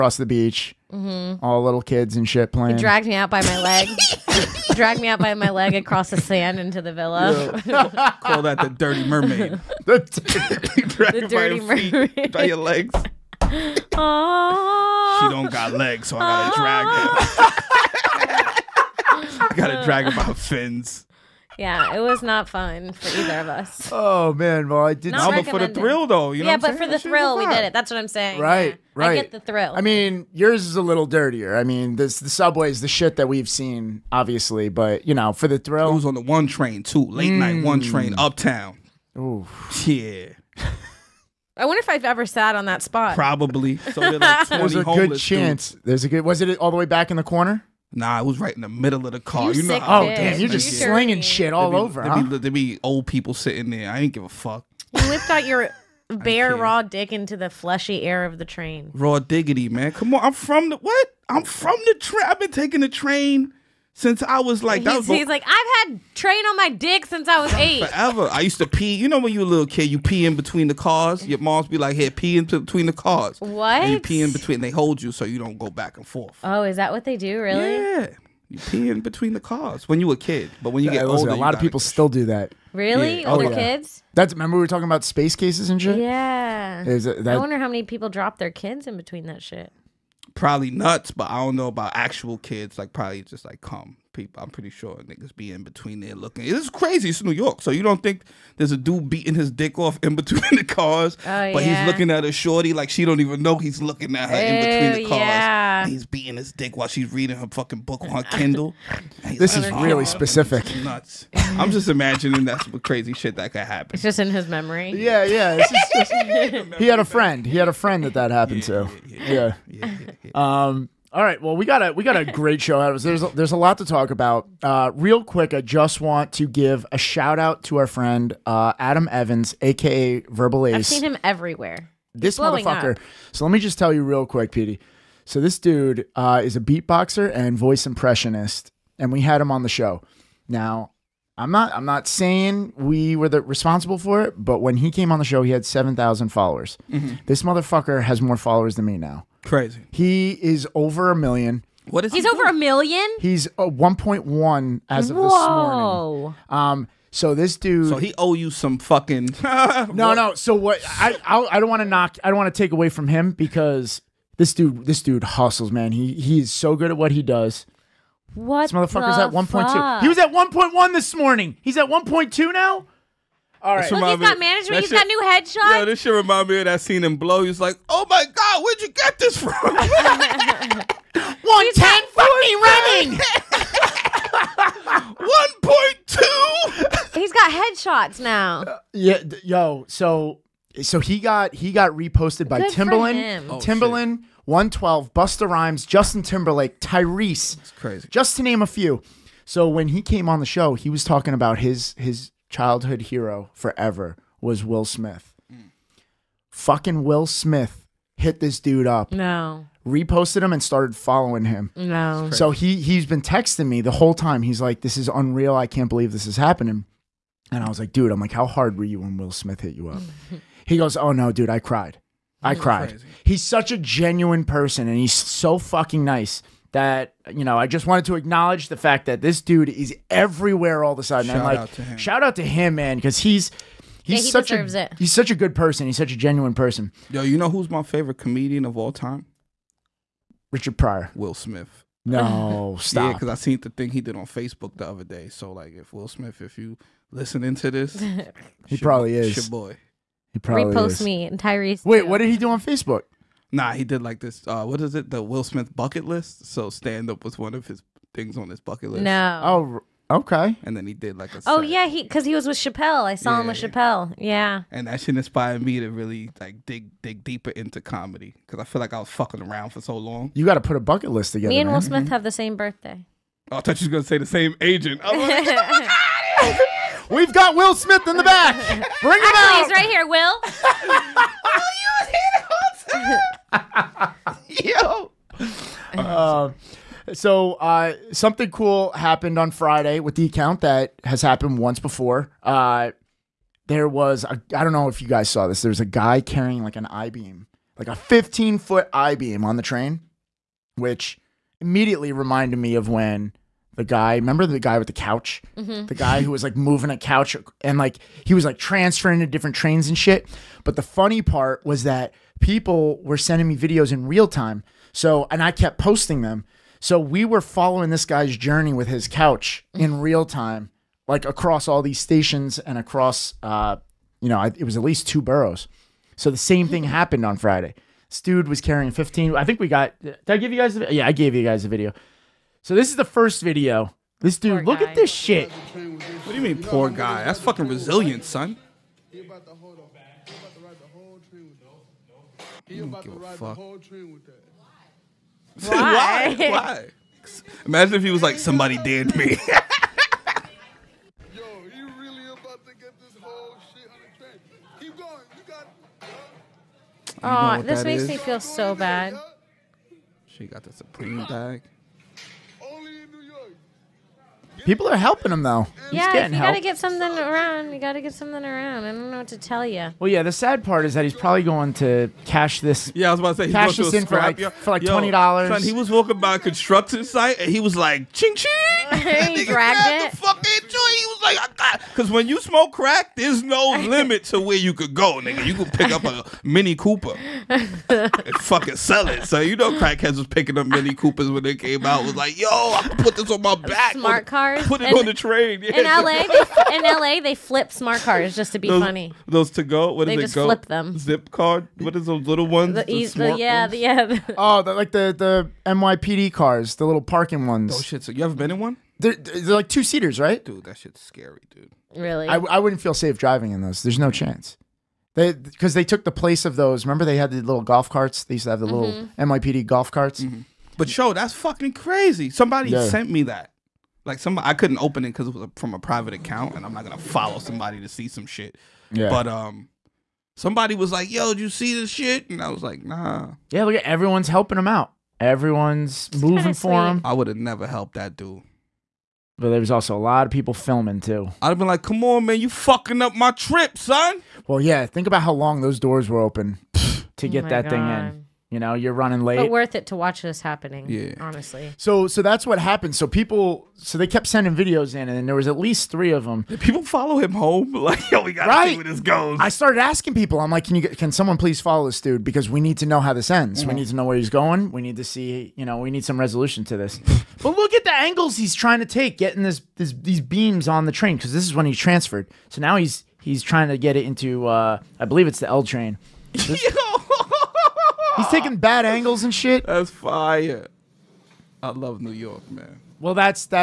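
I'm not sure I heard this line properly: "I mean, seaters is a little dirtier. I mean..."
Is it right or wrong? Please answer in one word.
wrong.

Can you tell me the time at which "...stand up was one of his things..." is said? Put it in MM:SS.
04:16.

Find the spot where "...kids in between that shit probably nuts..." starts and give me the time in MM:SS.
01:28.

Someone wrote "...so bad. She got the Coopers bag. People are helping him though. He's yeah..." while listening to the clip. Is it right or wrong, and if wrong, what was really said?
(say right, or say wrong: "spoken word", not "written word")
wrong: "Supreme", not "Coopers".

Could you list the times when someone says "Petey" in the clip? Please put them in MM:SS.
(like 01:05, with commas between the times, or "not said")
02:14.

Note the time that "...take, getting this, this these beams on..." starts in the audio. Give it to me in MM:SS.
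07:48.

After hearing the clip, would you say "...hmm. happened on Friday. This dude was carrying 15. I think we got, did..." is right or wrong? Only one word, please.
right.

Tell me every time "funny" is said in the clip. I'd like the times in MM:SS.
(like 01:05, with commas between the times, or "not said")
05:10, 06:38.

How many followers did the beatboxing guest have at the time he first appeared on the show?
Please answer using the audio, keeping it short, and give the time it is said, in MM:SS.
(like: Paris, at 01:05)
7,000, at 02:25.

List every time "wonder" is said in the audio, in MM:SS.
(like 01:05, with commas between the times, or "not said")
00:41, 01:27.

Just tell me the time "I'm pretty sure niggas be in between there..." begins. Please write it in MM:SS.
01:34.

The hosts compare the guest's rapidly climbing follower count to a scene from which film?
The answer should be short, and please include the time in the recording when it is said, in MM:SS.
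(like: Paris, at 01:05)
Blow, at 02:57.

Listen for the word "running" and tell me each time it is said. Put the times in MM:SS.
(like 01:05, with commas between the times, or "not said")
03:02, 07:28.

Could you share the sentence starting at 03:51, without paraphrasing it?
Shout and like, out to him.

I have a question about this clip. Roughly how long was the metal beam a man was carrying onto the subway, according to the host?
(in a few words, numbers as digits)
15 feet.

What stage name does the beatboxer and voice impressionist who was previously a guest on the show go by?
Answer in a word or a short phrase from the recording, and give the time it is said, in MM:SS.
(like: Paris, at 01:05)
Verbal Ace, at 02:10.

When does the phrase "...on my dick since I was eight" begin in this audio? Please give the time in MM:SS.
01:06.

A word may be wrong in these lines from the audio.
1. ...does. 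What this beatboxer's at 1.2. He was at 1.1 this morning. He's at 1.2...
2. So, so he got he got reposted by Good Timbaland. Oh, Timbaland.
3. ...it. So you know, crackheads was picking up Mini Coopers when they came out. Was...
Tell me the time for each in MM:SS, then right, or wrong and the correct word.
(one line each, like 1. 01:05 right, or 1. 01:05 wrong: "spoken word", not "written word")
1. 02:47 wrong: "motherfucker", not "beatboxer"
2. 03:09 right
3. 06:29 right.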